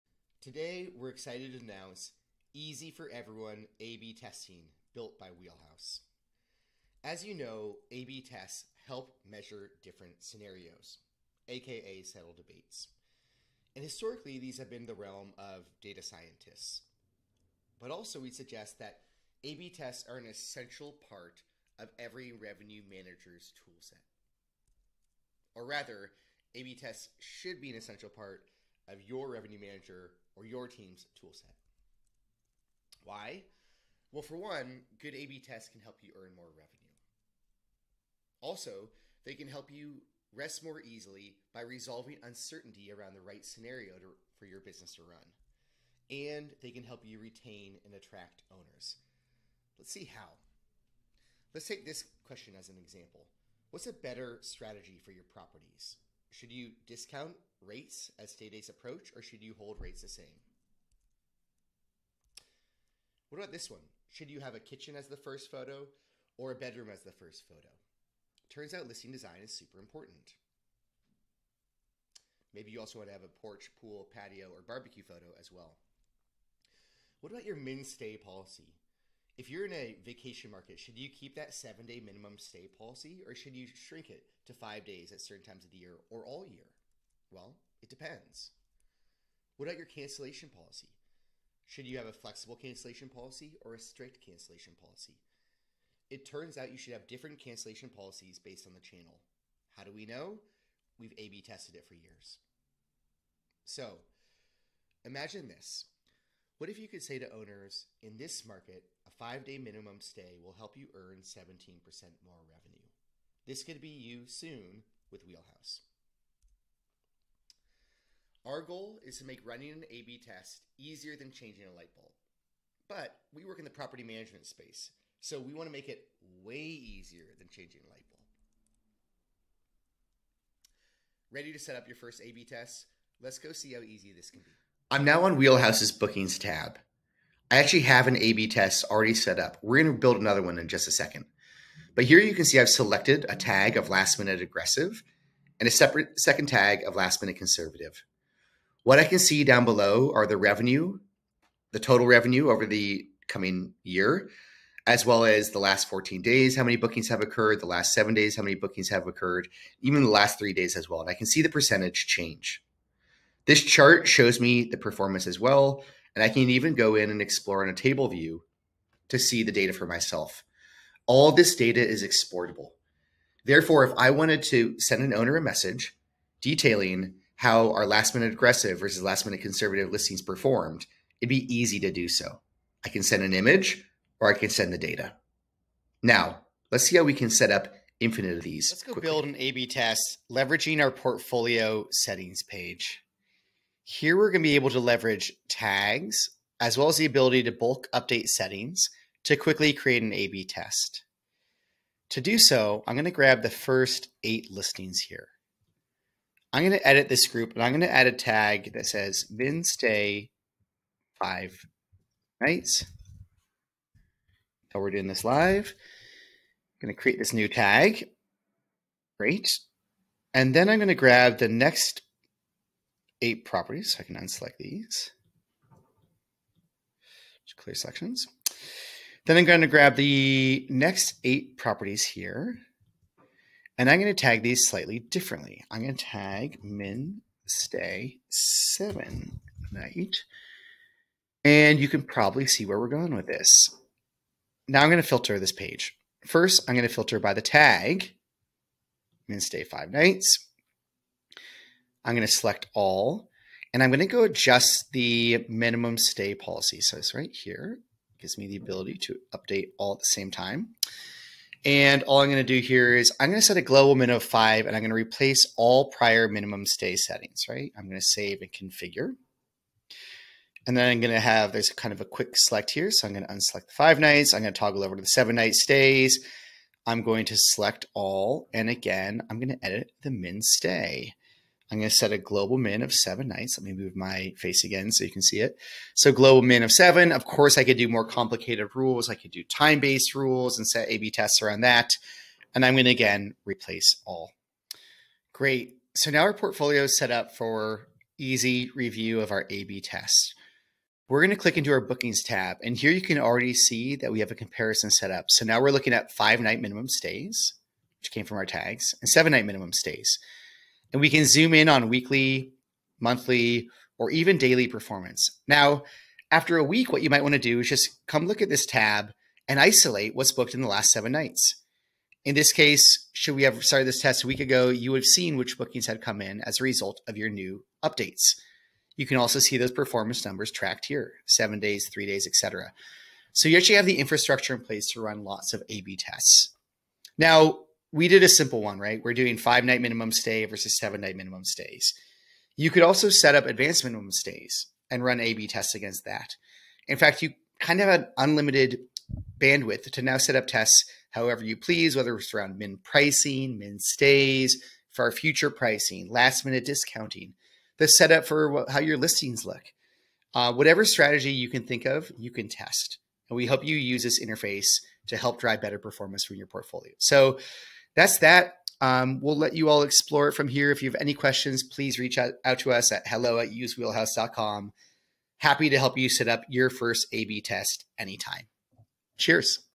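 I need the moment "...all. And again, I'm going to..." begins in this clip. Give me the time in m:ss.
4:37.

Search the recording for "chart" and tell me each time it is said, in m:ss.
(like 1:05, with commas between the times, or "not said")
2:43.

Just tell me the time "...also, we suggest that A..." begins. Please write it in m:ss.
0:17.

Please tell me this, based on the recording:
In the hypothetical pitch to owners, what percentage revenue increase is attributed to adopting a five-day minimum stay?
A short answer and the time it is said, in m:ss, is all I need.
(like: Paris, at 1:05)
17%, at 1:51.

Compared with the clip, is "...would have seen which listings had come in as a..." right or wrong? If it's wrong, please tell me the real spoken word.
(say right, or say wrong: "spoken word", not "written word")
wrong: "bookings", not "listings".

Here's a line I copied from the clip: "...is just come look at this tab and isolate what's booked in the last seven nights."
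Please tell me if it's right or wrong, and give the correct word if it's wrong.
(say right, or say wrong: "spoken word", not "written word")
right.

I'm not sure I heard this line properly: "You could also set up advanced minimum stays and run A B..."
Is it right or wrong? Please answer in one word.
right.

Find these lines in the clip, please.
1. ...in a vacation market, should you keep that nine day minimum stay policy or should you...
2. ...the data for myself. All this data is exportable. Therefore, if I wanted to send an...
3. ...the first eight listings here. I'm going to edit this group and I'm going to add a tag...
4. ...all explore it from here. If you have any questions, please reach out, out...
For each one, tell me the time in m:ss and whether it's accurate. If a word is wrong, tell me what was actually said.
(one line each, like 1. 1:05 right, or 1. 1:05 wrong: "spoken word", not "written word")
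1. 1:19 wrong: "seven", not "nine"
2. 2:49 right
3. 3:23 right
4. 6:09 right.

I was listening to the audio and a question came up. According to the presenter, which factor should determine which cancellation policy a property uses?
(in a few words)
the channel.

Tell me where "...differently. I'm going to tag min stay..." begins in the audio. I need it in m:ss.
3:54.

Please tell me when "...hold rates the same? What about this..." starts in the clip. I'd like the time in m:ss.
0:59.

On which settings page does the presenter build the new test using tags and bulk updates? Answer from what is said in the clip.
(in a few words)
portfolio settings.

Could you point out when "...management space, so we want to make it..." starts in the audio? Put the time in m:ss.
2:04.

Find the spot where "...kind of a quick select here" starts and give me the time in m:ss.
4:31.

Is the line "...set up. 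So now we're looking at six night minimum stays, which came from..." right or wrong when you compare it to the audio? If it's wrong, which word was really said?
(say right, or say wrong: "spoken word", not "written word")
wrong: "five", not "six".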